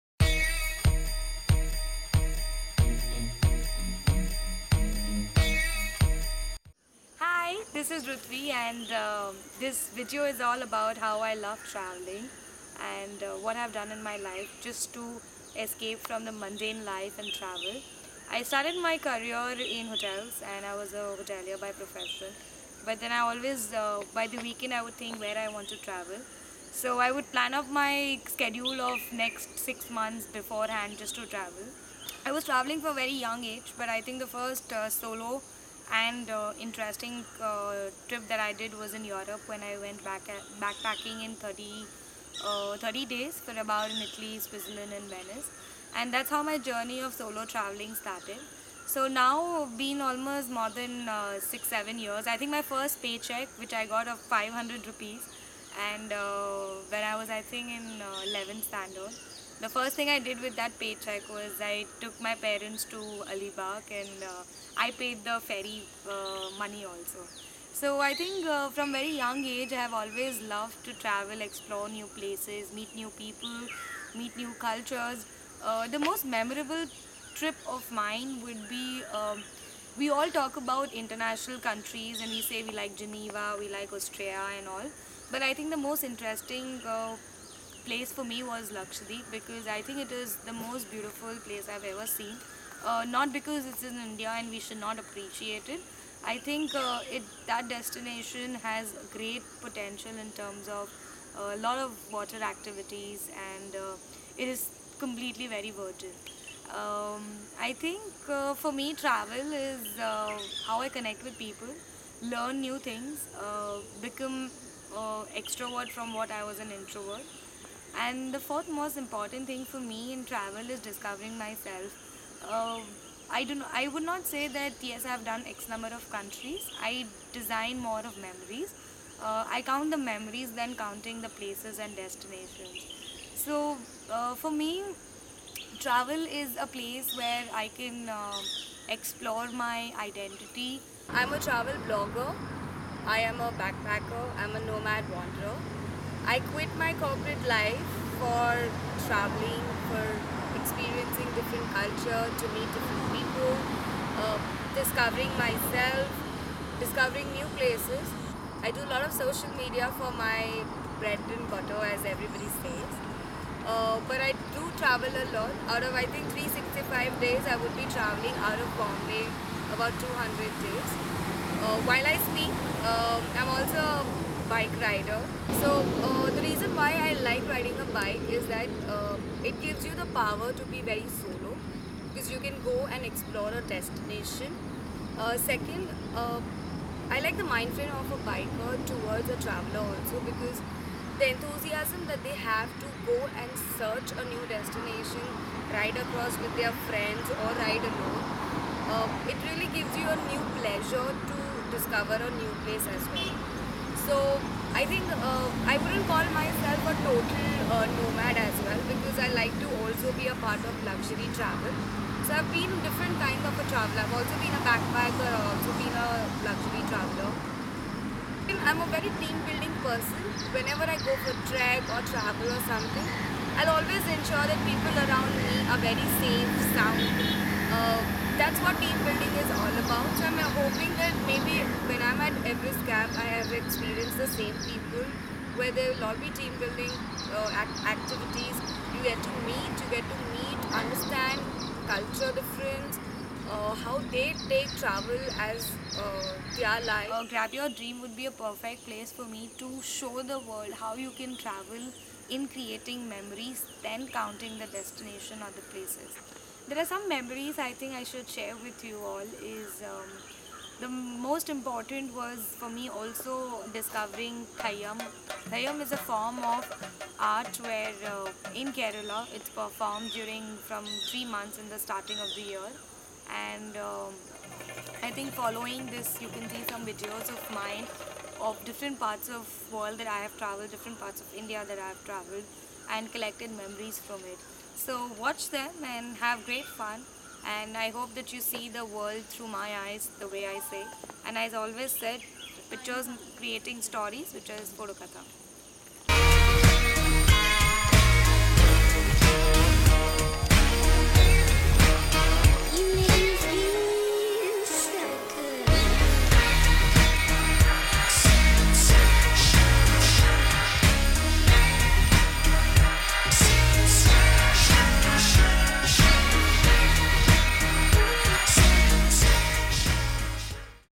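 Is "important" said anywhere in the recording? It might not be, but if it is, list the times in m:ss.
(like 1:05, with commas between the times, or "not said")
1:58, 4:21.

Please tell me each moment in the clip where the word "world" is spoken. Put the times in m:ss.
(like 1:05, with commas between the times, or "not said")
4:10, 4:39, 4:48.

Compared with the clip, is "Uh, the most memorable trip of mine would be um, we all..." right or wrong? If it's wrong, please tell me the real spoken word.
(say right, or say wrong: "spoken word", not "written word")
right.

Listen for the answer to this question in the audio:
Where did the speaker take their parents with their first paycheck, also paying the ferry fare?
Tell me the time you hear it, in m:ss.
1:03.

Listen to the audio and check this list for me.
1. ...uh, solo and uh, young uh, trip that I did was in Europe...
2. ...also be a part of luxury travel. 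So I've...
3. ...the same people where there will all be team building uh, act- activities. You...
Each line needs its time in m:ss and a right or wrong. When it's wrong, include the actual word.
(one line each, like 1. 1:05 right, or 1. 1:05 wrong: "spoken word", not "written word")
1. 0:34 wrong: "interesting", not "young"
2. 3:29 right
3. 3:54 right.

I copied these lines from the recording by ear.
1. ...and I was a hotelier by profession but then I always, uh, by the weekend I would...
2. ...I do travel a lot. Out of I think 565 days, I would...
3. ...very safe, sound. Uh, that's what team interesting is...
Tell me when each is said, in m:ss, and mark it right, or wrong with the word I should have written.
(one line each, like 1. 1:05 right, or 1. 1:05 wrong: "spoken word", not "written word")
1. 0:20 right
2. 2:44 wrong: "365", not "565"
3. 3:45 wrong: "building", not "interesting".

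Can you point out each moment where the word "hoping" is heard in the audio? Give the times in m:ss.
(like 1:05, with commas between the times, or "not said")
3:50.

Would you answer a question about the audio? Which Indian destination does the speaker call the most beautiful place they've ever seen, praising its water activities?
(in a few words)
Lakshadweep.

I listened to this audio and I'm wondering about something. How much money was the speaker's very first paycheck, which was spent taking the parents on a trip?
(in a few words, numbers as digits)
500 rupees.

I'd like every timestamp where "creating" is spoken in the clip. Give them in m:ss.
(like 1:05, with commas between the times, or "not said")
4:12, 4:53.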